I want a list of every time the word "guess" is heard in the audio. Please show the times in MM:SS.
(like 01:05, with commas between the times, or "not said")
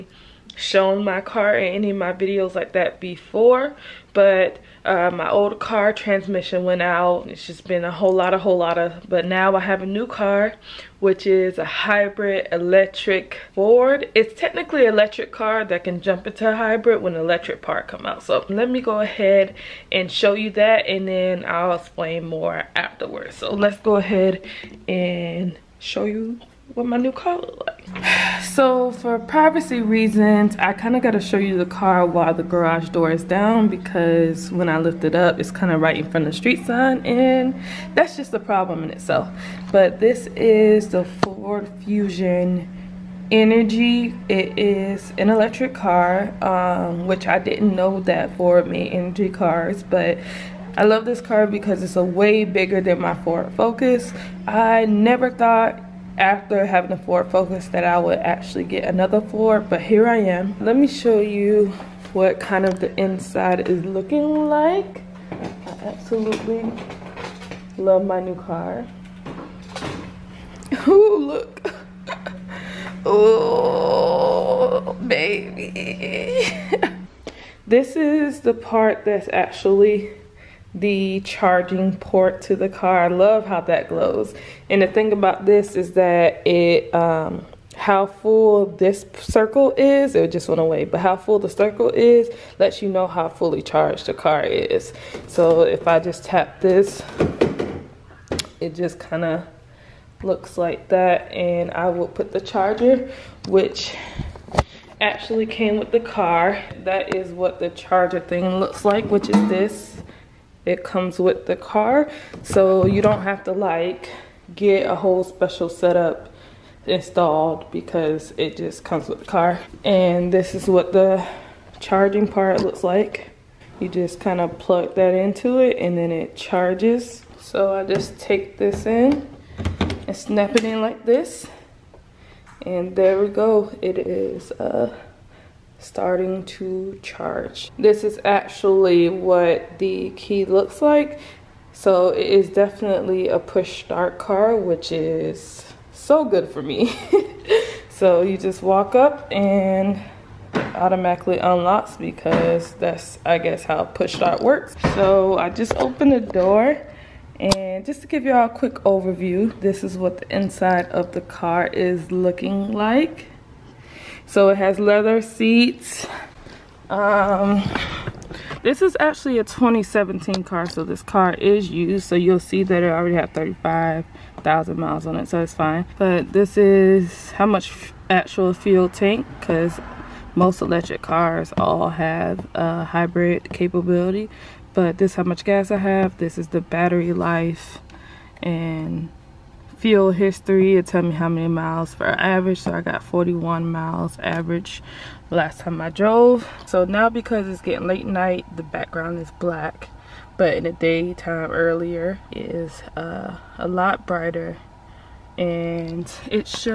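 02:33.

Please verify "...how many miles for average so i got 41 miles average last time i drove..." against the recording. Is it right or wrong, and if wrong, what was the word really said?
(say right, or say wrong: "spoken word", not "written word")
right.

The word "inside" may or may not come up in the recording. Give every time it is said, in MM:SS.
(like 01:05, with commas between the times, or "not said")
01:02, 02:40.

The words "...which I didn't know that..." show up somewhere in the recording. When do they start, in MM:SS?
00:47.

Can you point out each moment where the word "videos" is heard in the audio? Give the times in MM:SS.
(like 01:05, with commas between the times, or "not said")
00:02.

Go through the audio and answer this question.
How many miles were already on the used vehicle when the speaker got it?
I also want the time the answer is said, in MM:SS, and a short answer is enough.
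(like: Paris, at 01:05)
35,000, at 02:53.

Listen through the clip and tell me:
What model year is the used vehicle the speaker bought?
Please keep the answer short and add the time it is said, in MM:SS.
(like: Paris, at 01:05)
2017, at 02:49.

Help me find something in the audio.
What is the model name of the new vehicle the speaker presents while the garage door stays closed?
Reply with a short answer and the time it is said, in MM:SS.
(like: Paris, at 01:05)
Ford Fusion Energi, at 00:41.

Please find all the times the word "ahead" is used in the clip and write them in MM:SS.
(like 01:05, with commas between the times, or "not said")
00:19, 00:23.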